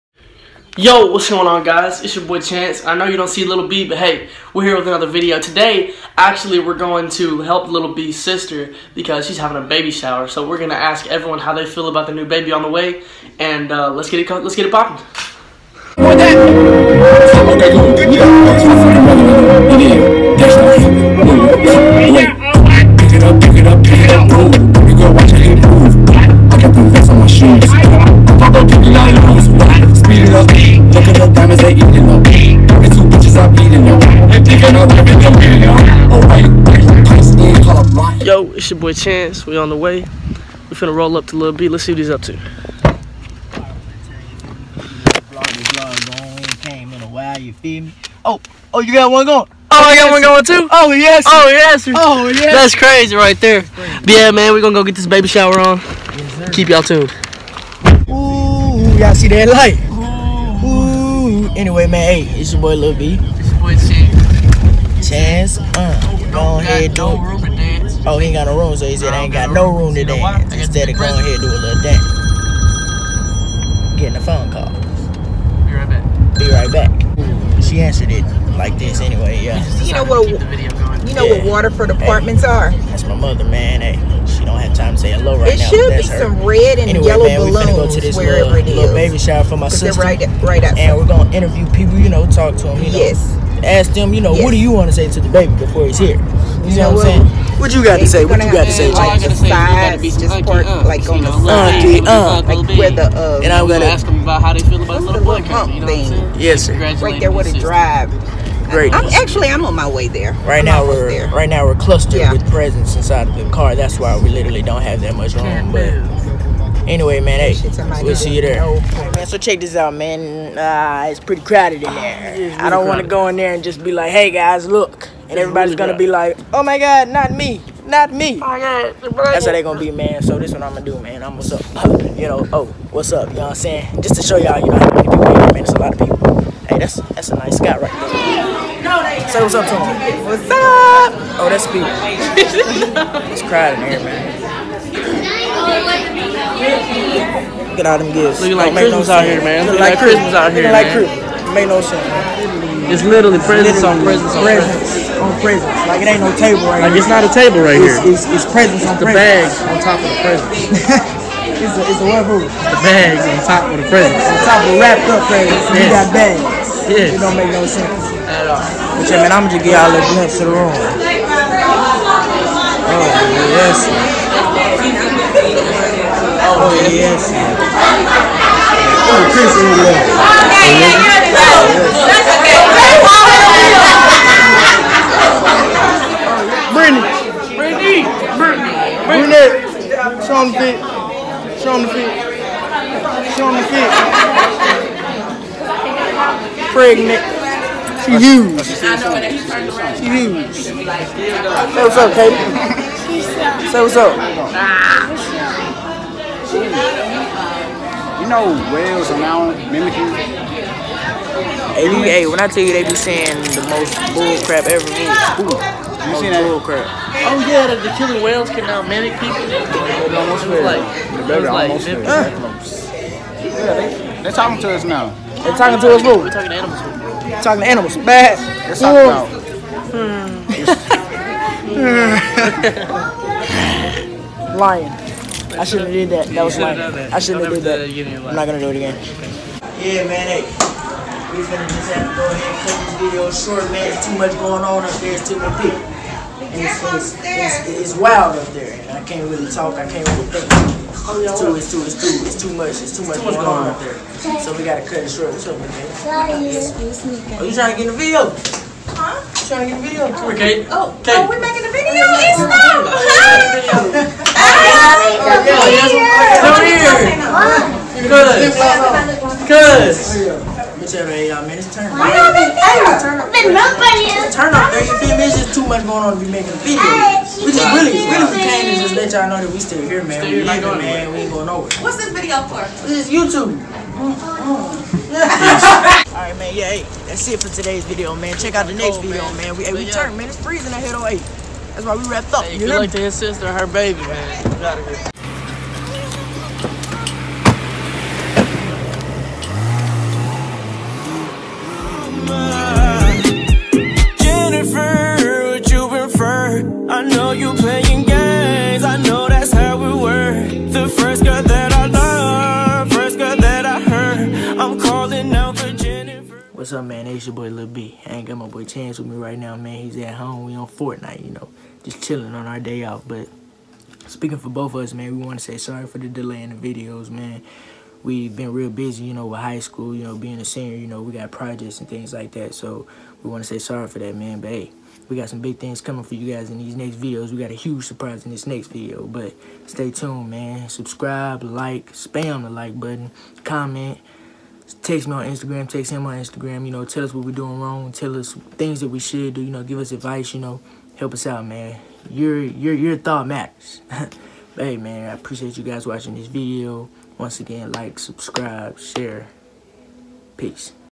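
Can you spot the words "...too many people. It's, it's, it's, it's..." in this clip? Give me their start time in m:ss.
4:05.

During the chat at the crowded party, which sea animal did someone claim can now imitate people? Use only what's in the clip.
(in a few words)
Killer whales.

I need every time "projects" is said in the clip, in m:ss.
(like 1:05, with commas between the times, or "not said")
5:31.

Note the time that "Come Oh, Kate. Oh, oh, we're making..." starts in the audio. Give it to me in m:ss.
4:20.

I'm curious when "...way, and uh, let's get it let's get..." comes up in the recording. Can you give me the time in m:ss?
0:12.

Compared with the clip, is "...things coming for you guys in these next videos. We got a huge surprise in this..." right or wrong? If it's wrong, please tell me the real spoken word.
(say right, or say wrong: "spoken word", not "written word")
right.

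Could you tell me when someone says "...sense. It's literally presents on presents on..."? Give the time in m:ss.
2:31.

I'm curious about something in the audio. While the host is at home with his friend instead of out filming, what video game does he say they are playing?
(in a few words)
Fortnite.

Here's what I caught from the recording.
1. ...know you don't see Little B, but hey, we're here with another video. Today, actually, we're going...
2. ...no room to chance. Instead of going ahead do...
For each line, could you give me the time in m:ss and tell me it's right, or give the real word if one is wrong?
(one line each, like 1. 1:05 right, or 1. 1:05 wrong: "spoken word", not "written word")
1. 0:02 right
2. 1:09 wrong: "dance", not "chance".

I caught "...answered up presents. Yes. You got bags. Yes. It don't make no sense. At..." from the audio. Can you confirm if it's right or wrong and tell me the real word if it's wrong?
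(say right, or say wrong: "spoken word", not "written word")
wrong: "wrapped", not "answered".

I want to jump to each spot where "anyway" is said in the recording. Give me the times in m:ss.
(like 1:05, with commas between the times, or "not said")
1:01, 1:19, 1:26, 1:56.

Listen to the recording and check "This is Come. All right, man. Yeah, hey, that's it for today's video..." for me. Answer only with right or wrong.
wrong.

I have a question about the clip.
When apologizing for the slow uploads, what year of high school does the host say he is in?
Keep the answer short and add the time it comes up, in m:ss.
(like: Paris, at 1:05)
Senior, at 5:30.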